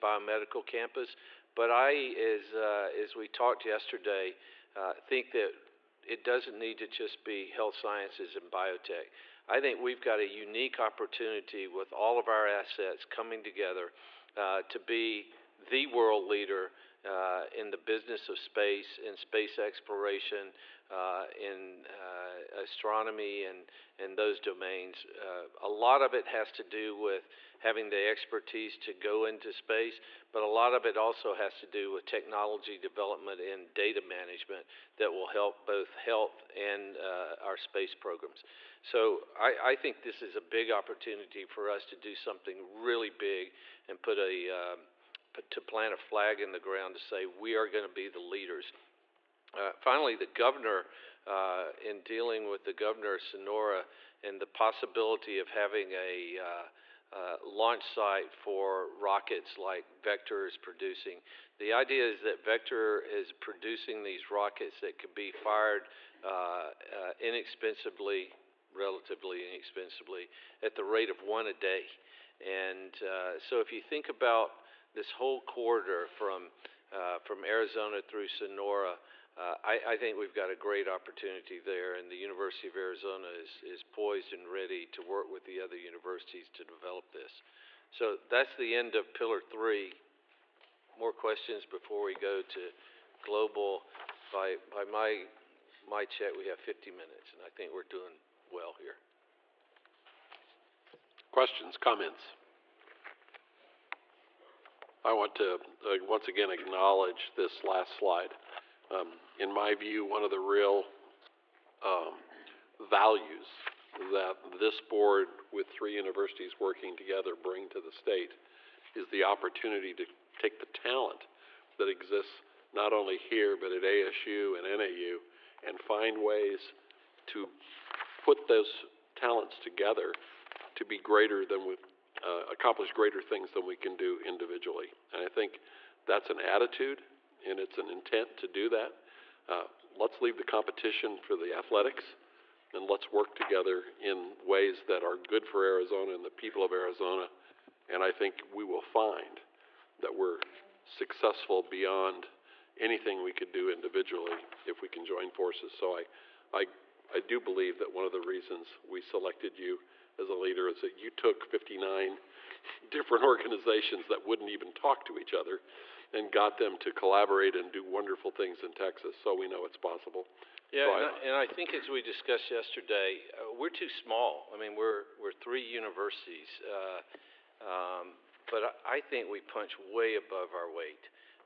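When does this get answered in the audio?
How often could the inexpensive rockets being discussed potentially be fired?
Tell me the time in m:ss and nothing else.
1:11.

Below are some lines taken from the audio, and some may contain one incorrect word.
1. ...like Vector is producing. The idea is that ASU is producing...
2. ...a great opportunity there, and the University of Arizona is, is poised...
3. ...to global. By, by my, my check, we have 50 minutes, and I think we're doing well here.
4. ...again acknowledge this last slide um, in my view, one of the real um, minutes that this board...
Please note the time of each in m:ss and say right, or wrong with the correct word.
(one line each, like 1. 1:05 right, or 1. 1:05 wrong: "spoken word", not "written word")
1. 0:59 wrong: "Vector", not "ASU"
2. 1:20 right
3. 1:32 right
4. 1:46 wrong: "values", not "minutes".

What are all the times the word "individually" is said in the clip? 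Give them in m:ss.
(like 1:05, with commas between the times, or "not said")
2:14, 2:33.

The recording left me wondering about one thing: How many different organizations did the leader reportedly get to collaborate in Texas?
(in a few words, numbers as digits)
59.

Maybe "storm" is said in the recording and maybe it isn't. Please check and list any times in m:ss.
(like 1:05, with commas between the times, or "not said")
not said.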